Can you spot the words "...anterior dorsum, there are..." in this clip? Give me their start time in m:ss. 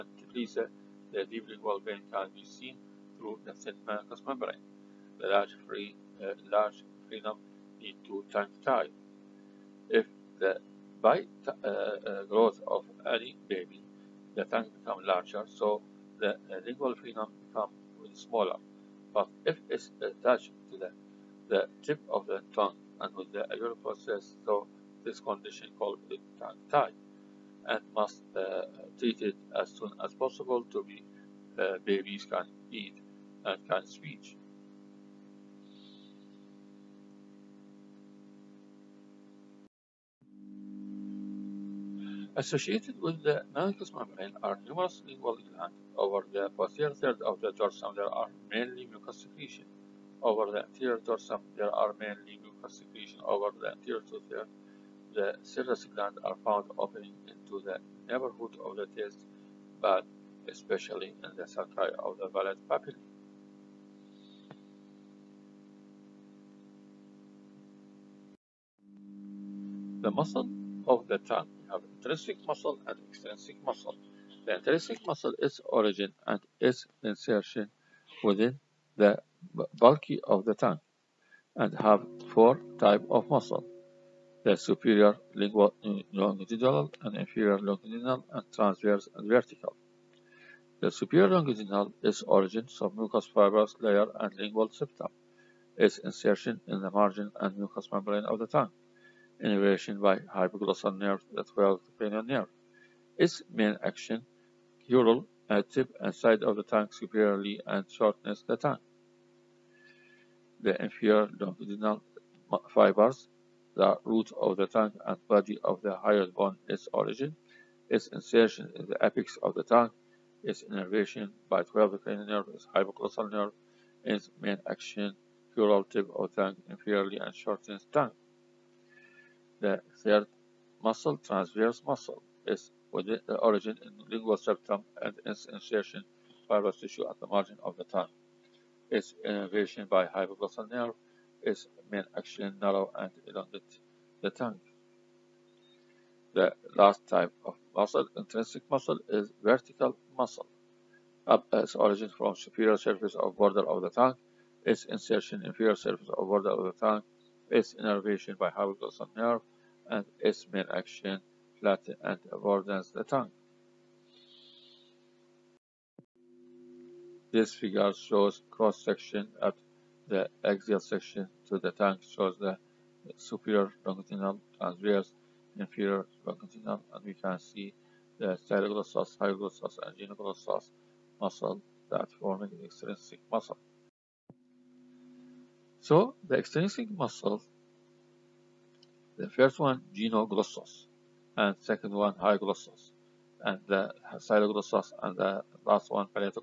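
0:50.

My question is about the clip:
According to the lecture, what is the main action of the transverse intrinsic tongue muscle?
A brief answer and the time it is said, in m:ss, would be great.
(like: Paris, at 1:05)
Narrow and elongate the tongue, at 2:22.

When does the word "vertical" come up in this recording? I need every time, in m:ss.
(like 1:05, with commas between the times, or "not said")
1:29, 2:29.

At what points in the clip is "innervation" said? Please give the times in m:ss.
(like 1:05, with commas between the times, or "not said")
1:39, 2:00, 2:19, 2:37.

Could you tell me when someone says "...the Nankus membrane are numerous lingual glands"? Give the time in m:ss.
0:43.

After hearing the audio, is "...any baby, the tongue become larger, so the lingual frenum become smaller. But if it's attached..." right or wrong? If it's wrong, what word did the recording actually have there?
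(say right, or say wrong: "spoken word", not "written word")
right.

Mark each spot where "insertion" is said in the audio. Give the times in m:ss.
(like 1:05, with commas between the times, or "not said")
1:17, 1:35, 1:58, 2:15, 2:34.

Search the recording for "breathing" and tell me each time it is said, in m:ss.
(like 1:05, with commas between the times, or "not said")
not said.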